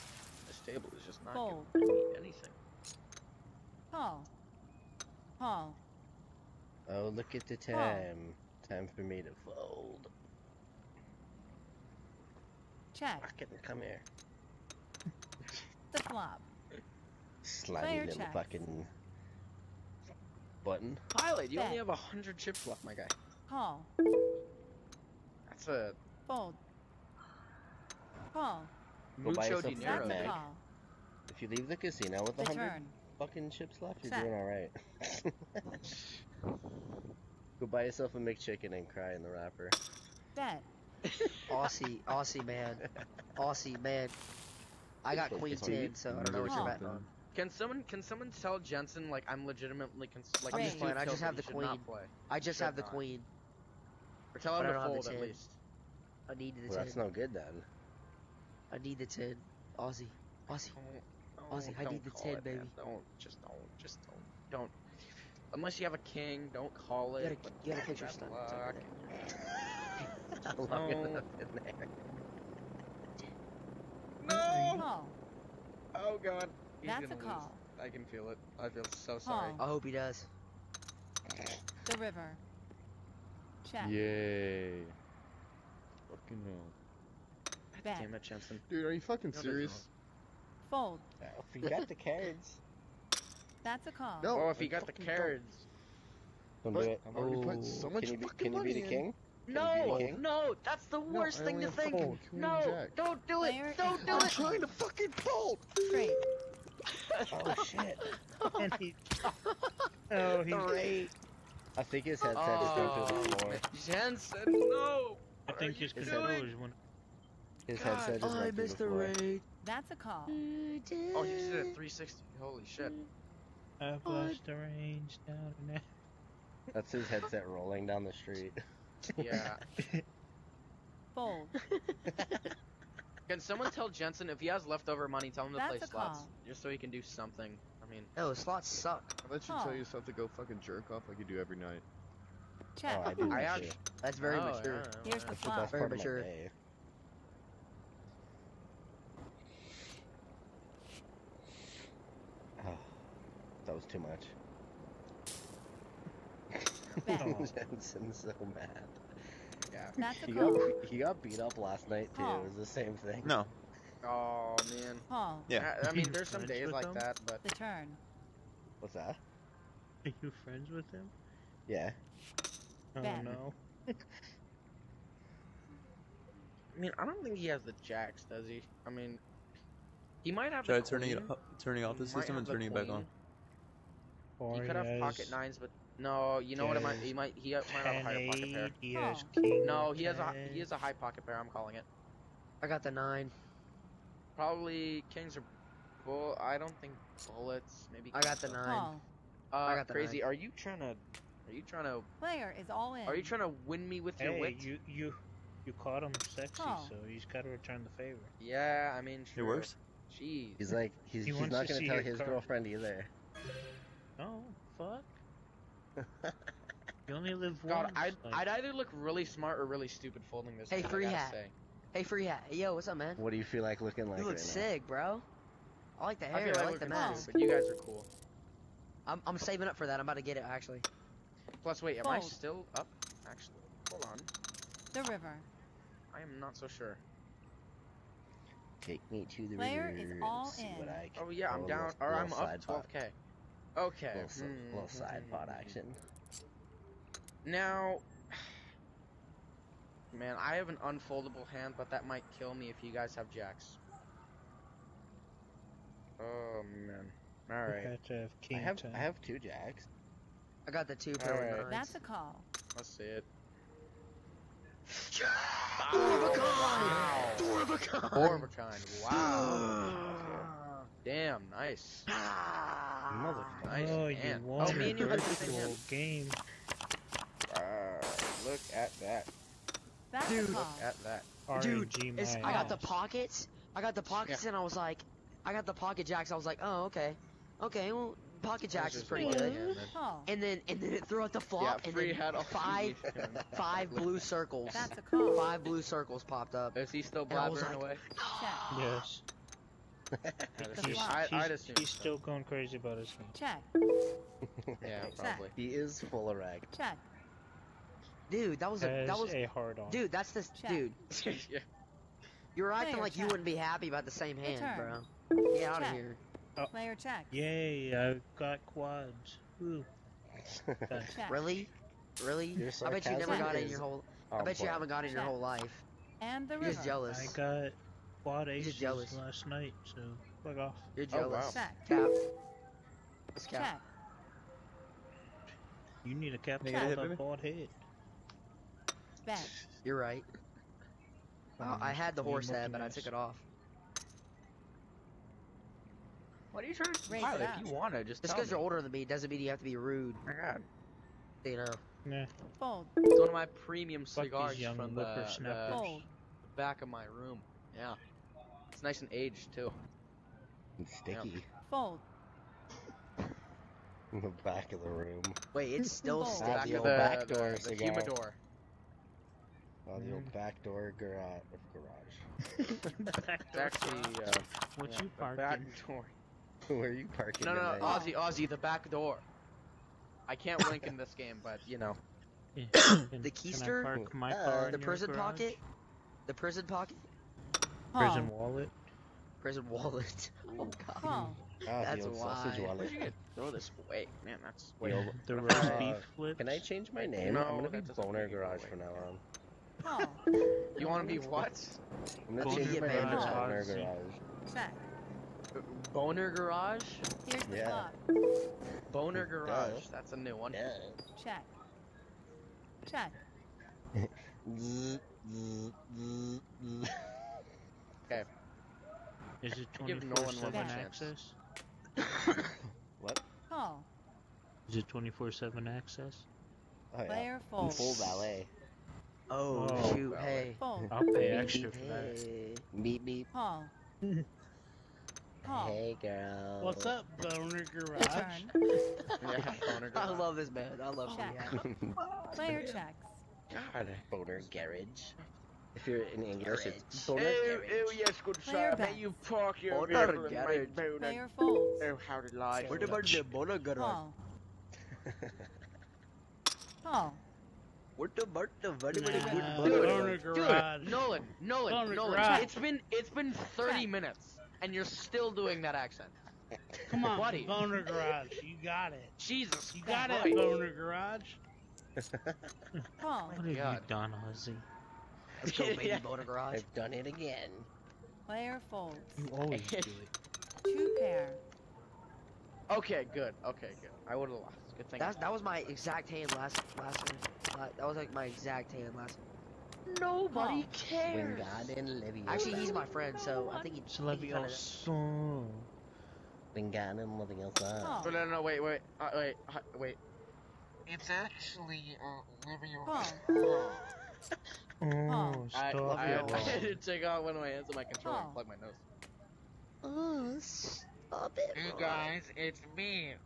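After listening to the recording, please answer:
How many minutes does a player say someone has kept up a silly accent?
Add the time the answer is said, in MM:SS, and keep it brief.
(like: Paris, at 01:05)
30, at 07:43.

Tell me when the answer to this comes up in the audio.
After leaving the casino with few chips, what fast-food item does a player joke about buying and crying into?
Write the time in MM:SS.
00:38.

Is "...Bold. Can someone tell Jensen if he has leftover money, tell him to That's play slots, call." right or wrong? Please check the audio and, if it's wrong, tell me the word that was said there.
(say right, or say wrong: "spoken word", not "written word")
right.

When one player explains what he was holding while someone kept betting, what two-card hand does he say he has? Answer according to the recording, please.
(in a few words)
Queen ten.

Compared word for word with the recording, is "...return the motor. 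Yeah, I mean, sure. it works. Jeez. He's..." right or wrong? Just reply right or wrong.
wrong.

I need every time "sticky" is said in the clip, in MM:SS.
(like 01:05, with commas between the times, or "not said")
06:00, 06:06.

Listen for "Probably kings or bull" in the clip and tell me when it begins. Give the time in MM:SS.
03:14.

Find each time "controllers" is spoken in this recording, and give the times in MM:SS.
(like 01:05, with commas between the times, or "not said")
01:55, 08:27.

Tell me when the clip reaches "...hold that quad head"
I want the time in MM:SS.
05:36.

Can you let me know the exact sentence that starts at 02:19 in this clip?
That should tell yourself to go fucking jerk off like you do every night.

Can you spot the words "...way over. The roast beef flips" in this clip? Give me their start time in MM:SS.
06:34.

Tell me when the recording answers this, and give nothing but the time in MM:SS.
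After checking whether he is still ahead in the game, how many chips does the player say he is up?
04:02.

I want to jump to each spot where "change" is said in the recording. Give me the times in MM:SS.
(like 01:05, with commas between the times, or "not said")
06:36, 06:42.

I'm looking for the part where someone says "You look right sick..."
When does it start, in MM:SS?
03:44.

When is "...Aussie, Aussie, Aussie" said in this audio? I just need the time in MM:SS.
00:59.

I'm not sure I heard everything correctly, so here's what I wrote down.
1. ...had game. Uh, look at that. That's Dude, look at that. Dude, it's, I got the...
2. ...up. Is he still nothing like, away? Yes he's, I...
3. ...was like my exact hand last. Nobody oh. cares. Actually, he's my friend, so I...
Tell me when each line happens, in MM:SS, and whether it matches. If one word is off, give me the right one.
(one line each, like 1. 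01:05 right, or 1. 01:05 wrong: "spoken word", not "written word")
1. 04:35 right
2. 04:56 wrong: "blabbering", not "nothing"
3. 08:07 right.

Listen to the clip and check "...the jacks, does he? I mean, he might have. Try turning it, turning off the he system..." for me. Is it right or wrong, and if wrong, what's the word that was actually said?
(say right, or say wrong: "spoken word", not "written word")
right.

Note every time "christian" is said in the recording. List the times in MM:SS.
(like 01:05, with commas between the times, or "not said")
not said.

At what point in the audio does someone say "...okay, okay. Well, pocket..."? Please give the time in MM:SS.
04:46.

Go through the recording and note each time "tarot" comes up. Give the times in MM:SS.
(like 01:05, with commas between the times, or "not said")
not said.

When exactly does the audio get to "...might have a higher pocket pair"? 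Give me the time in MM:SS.
03:07.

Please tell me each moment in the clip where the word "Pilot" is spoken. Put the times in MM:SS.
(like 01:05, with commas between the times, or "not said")
00:21, 05:47.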